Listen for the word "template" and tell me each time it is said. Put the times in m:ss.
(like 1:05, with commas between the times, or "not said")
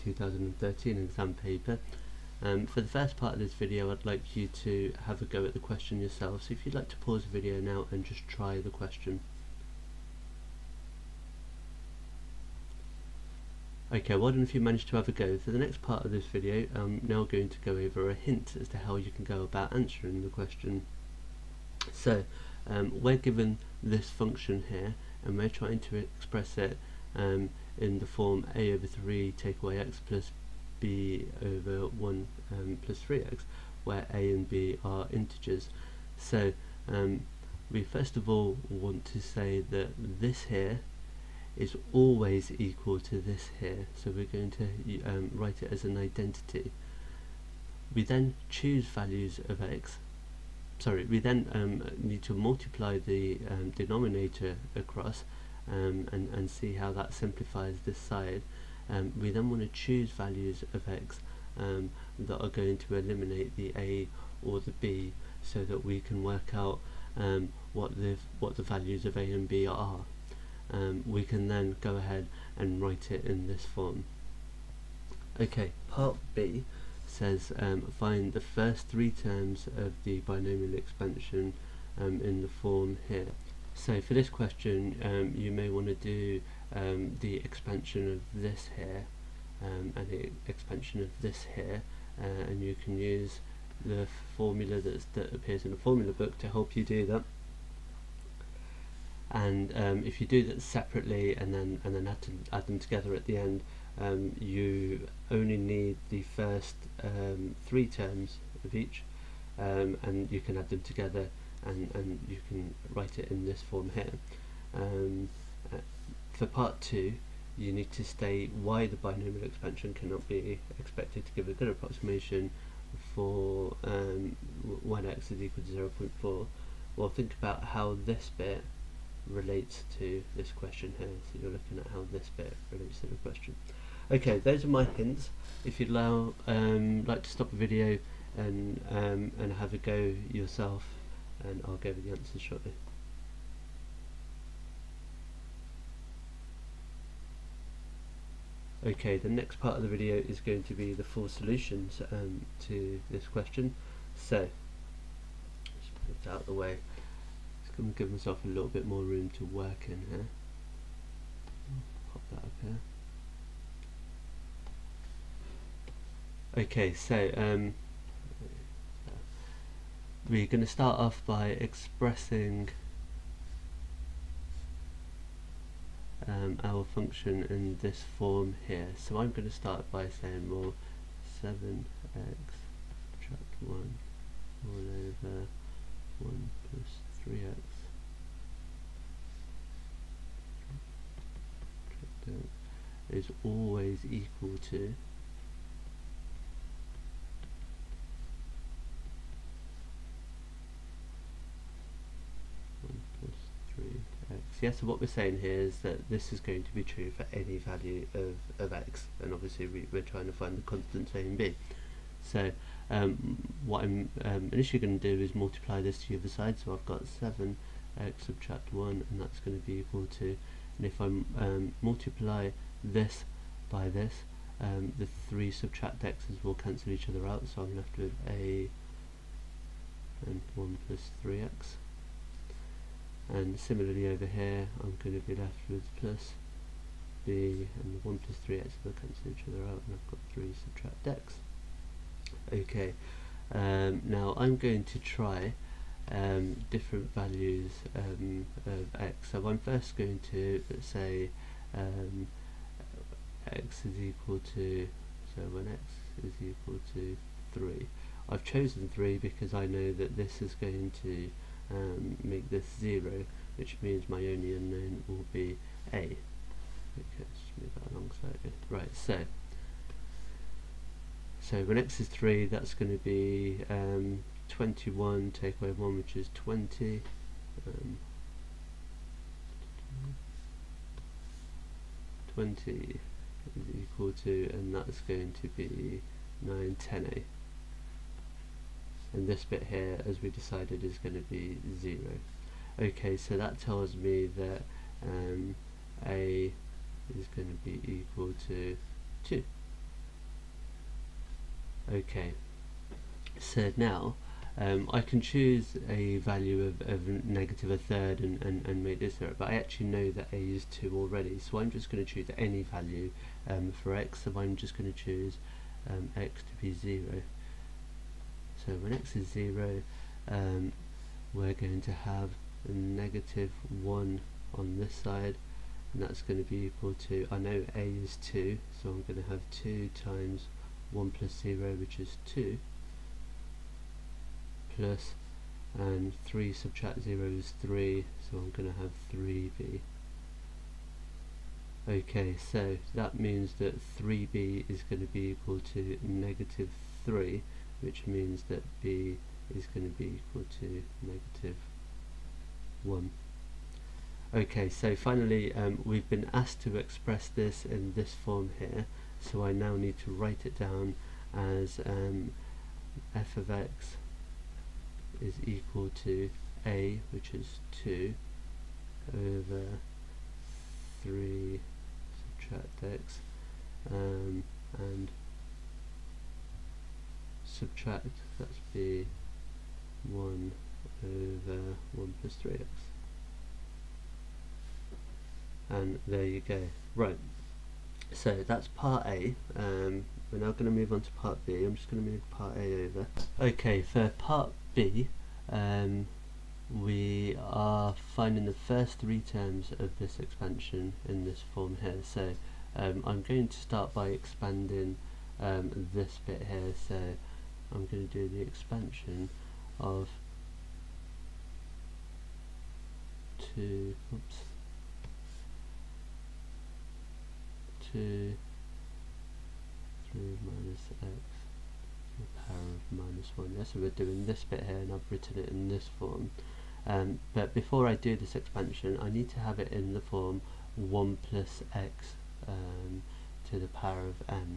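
not said.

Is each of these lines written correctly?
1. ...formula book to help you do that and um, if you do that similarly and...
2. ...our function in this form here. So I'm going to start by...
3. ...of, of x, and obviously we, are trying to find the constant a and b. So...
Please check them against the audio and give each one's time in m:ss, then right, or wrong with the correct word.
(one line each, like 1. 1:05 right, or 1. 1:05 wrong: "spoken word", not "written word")
1. 1:35 wrong: "separately", not "similarly"
2. 2:56 right
3. 3:28 right.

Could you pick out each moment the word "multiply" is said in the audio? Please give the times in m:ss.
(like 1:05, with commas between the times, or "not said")
0:52, 3:35, 3:41.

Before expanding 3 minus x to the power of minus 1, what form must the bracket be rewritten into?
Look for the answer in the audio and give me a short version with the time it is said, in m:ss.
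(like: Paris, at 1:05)
1 plus x, at 7:10.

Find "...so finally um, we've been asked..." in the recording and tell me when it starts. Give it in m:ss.
5:54.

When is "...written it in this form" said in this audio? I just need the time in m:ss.
7:05.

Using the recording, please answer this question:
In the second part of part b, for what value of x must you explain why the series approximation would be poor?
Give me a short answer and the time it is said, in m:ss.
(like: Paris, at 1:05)
0.4, at 2:05.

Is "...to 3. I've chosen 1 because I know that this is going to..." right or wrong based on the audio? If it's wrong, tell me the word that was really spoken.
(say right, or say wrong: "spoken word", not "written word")
wrong: "3", not "1".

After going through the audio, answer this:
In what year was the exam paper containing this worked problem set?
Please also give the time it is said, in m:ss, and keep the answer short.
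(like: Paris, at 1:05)
2013, at 0:00.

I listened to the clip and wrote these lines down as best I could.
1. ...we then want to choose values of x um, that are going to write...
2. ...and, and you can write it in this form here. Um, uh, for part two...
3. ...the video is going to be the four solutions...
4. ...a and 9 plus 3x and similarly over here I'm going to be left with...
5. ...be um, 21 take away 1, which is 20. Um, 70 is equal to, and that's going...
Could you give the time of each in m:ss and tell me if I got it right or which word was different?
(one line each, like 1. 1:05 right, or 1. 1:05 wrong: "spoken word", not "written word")
1. 0:59 wrong: "eliminate", not "write"
2. 1:51 right
3. 2:29 right
4. 3:48 wrong: "1", not "9"
5. 4:33 wrong: "20", not "70".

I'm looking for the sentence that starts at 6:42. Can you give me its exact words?
So um, I'm going to start by expanding um, this bit here.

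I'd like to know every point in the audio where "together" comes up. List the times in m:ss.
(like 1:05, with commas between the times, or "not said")
1:42, 1:50.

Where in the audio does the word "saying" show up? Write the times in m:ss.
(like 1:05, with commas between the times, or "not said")
3:00, 3:25.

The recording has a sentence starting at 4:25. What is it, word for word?
Okay, let's move that along slightly.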